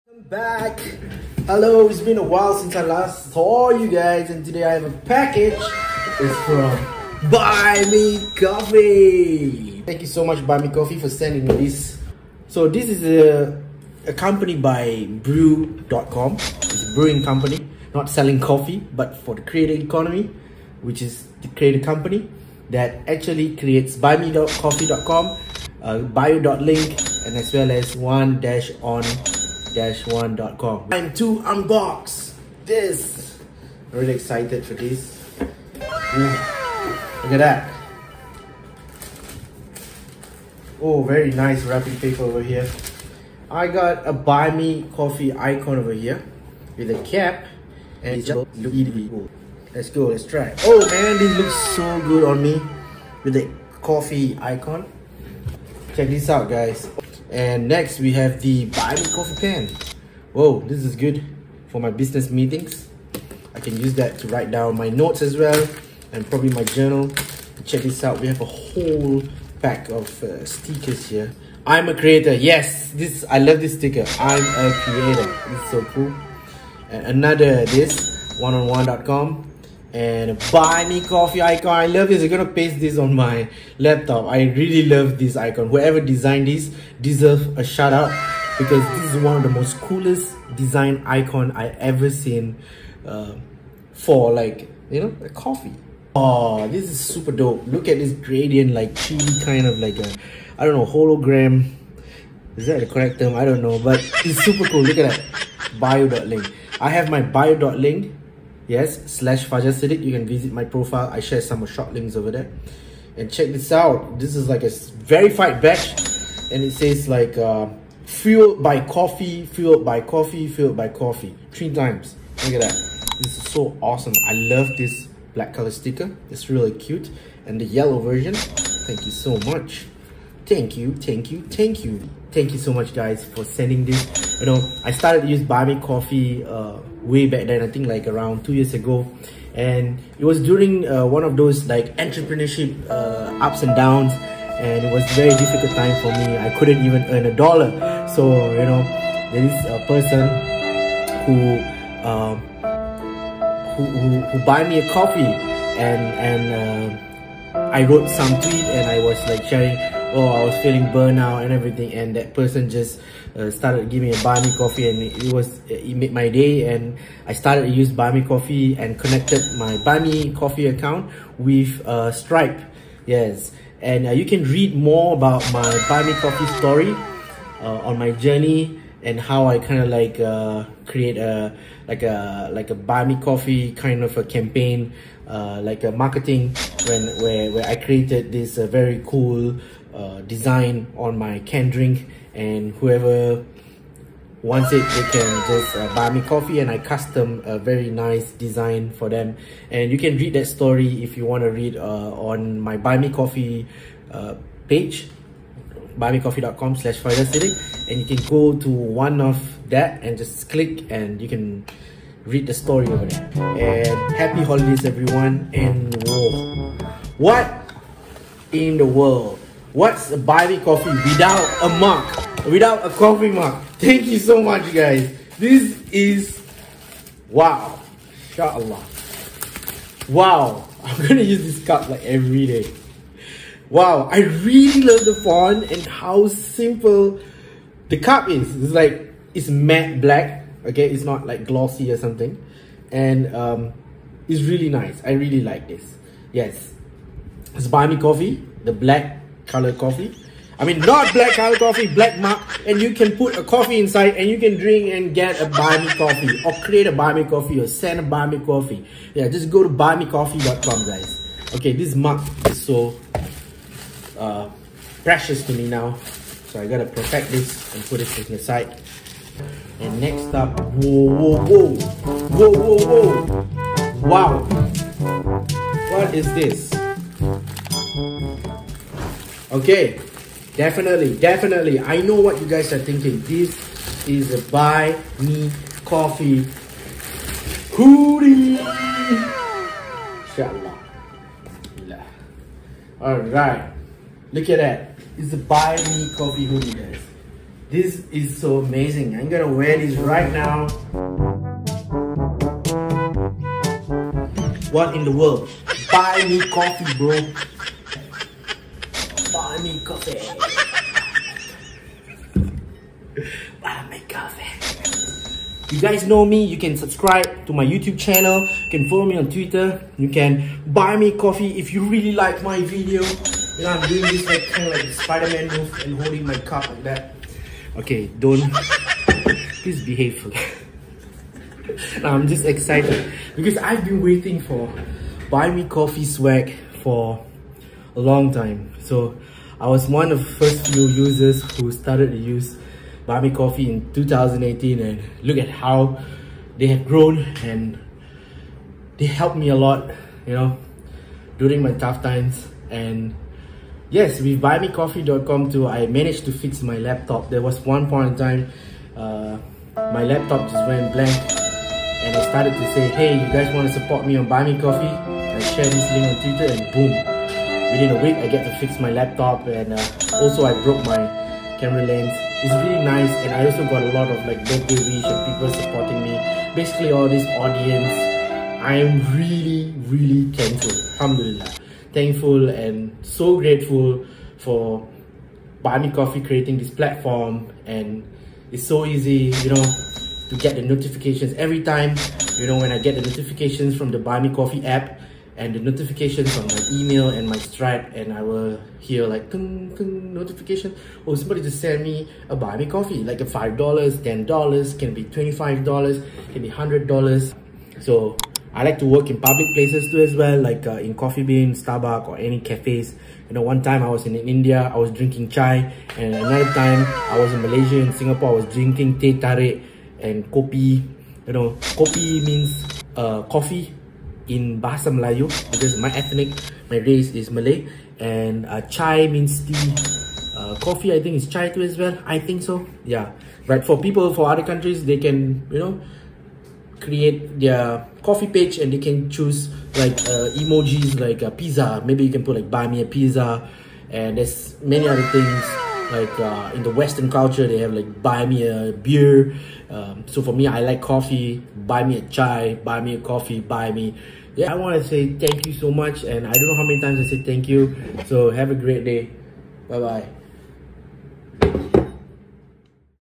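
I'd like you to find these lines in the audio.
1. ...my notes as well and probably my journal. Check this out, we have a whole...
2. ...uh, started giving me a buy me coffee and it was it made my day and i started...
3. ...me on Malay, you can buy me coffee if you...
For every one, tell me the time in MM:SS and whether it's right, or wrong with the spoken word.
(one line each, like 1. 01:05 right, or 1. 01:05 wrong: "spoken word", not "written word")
1. 01:04 right
2. 02:43 right
3. 05:19 wrong: "Twitter", not "Malay".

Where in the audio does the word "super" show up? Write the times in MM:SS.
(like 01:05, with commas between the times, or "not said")
01:36, 01:44.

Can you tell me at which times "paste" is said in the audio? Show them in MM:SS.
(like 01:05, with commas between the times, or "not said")
01:22.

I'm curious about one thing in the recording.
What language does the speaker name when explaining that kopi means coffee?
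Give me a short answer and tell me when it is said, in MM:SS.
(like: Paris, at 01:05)
Bahasa Melayu, at 07:04.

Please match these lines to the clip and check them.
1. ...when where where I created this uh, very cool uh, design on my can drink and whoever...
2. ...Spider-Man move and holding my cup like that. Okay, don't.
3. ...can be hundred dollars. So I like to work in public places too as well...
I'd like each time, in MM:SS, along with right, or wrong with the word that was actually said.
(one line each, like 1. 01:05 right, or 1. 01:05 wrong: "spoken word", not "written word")
1. 03:06 right
2. 05:24 right
3. 06:46 right.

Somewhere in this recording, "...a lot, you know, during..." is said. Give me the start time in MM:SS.
05:49.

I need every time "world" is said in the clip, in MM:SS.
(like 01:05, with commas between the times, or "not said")
03:38, 05:05.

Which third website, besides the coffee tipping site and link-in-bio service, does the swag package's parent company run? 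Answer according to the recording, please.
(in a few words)
one-on-one.com.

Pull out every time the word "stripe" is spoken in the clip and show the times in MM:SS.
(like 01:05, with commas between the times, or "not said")
02:52, 06:37.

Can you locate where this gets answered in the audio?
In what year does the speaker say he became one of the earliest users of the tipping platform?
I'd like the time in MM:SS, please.
05:43.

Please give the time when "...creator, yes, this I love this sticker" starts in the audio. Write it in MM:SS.
01:11.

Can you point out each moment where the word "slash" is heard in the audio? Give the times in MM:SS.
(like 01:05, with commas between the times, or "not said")
01:49, 03:26.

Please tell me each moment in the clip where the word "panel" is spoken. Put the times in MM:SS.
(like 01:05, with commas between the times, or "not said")
not said.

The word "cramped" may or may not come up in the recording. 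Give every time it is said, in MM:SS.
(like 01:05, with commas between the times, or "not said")
not said.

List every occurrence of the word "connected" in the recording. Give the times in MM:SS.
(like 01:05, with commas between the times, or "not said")
02:48.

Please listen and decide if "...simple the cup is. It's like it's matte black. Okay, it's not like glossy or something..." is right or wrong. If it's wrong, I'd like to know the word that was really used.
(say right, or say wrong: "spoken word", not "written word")
right.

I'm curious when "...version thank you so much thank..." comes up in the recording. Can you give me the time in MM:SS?
02:07.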